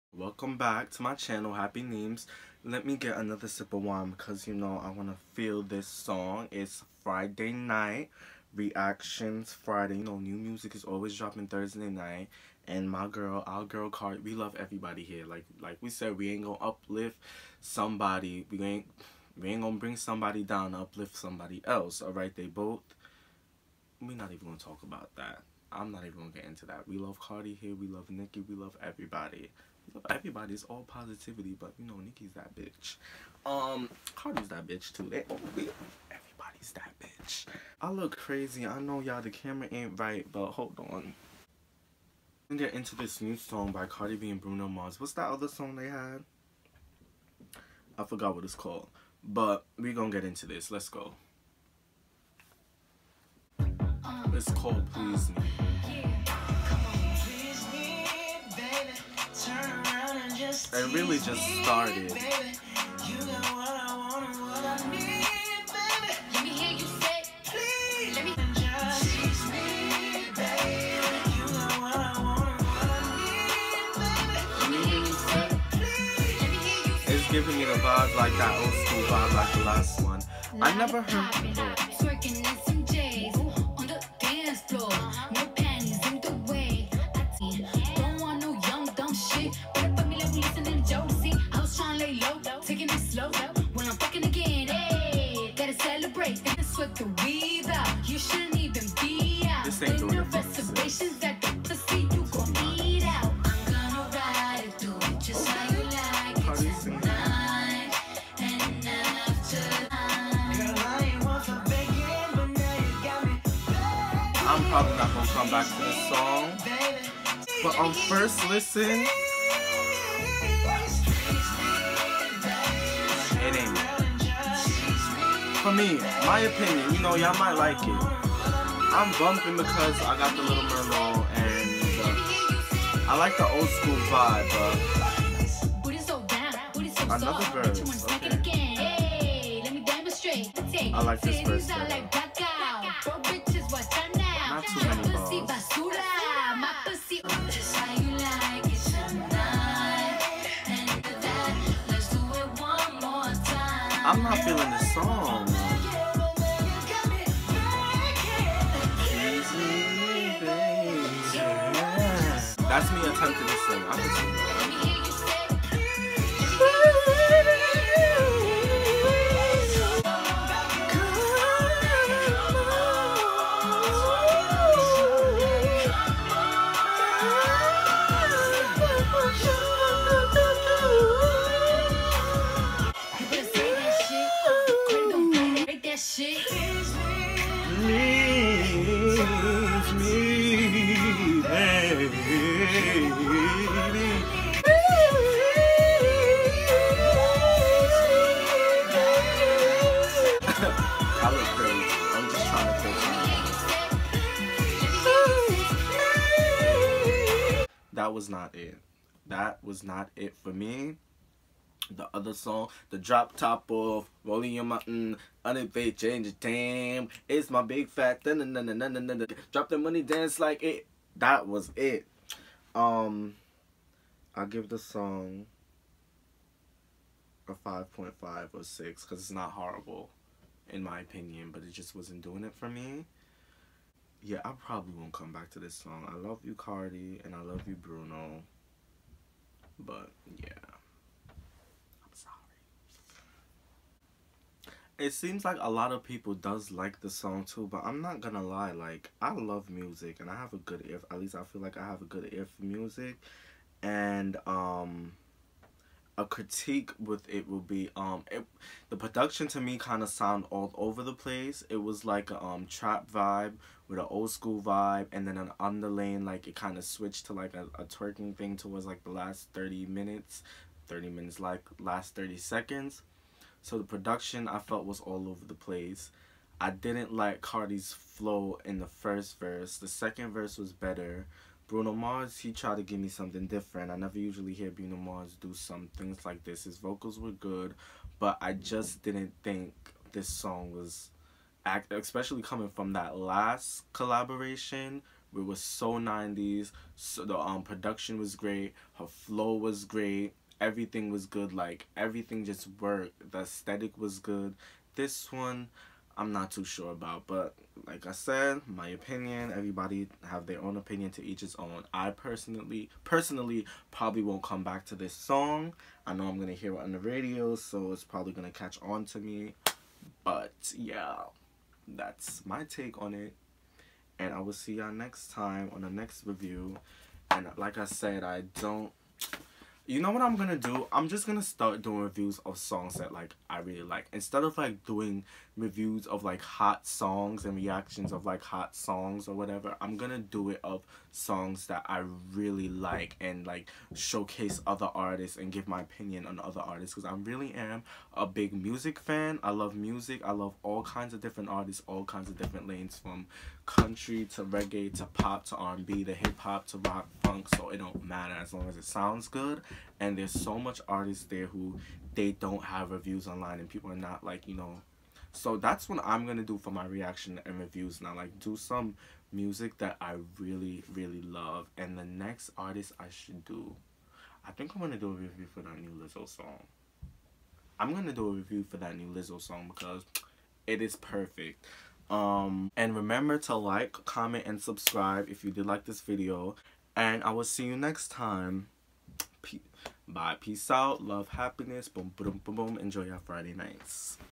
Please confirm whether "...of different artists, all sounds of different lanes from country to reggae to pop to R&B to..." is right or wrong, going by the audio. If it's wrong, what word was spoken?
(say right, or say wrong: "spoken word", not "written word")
wrong: "kinds", not "sounds".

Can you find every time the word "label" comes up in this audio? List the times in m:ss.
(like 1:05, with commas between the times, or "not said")
not said.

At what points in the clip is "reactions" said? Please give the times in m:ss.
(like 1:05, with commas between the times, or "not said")
0:08, 5:37, 6:06.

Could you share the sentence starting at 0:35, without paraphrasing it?
They all we, everybody's that bitch.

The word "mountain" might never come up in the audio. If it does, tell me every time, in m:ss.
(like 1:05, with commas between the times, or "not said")
3:34.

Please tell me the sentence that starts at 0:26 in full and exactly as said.
We love Cardi here, we love Nicki, we love everybody.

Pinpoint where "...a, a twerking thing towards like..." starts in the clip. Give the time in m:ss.
4:27.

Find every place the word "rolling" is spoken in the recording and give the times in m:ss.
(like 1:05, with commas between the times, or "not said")
3:34.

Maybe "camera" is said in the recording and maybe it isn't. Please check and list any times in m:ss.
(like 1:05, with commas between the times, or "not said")
0:39.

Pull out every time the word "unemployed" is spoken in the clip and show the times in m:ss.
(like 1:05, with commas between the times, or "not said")
3:35.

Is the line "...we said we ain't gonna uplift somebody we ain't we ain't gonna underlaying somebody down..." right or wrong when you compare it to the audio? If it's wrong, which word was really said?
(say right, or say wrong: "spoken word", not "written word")
wrong: "bring", not "underlaying".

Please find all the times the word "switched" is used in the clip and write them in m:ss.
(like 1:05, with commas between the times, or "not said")
4:26.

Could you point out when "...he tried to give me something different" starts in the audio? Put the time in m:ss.
4:42.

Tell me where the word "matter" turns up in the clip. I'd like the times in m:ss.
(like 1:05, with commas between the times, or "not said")
5:58.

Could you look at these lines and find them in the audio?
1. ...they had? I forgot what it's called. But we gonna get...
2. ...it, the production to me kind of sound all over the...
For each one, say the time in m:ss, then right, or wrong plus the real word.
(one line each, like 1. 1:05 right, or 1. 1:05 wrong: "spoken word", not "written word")
1. 0:45 right
2. 4:18 right.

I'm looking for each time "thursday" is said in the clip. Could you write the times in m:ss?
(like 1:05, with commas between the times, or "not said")
0:11.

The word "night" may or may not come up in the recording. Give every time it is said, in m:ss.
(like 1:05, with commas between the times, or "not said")
0:07, 0:11, 6:33.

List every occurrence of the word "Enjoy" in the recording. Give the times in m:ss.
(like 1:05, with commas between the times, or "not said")
6:32.